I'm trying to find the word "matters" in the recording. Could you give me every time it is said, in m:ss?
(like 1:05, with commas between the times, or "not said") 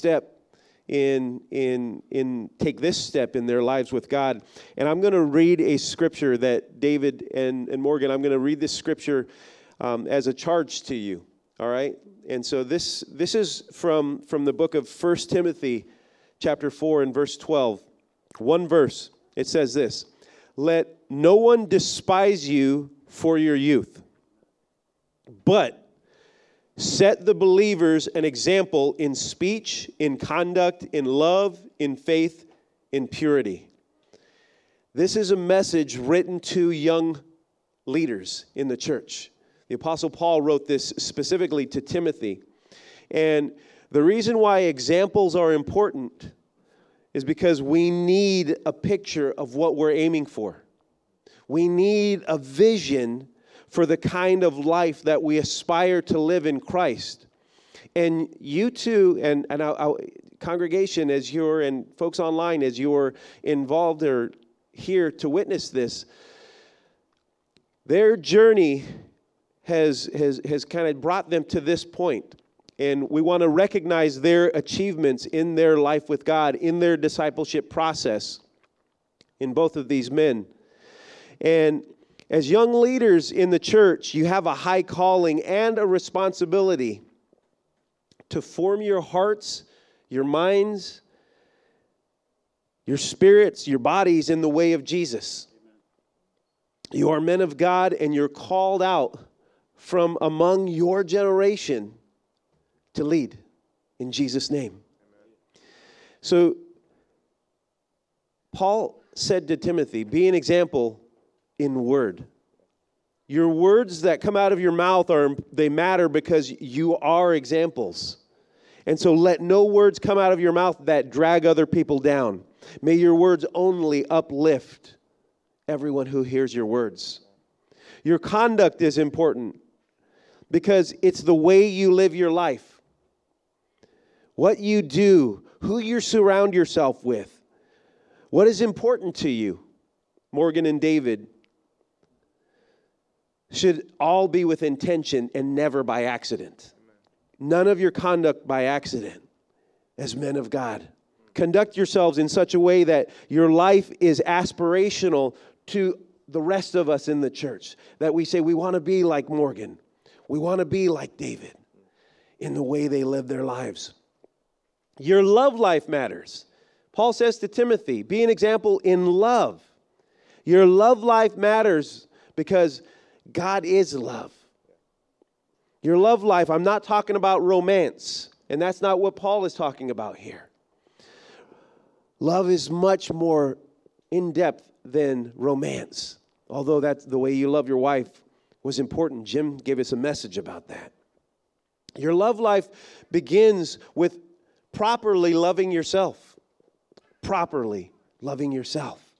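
1:55, 2:45, 2:51.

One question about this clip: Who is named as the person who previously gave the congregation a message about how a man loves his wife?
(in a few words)
Jim.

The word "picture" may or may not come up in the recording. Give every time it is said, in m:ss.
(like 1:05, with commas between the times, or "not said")
0:48.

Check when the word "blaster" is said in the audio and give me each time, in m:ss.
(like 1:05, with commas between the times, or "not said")
not said.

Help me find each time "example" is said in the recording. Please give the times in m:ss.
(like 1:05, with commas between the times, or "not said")
0:28, 0:44, 1:50, 1:57, 2:48.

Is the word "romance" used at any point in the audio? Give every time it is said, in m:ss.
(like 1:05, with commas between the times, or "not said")
2:57, 3:05.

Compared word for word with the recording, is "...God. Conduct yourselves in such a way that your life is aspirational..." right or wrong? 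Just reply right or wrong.
right.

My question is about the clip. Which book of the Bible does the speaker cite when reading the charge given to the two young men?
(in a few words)
First Timothy.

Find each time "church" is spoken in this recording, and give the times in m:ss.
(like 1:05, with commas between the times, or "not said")
0:38, 1:23, 2:37.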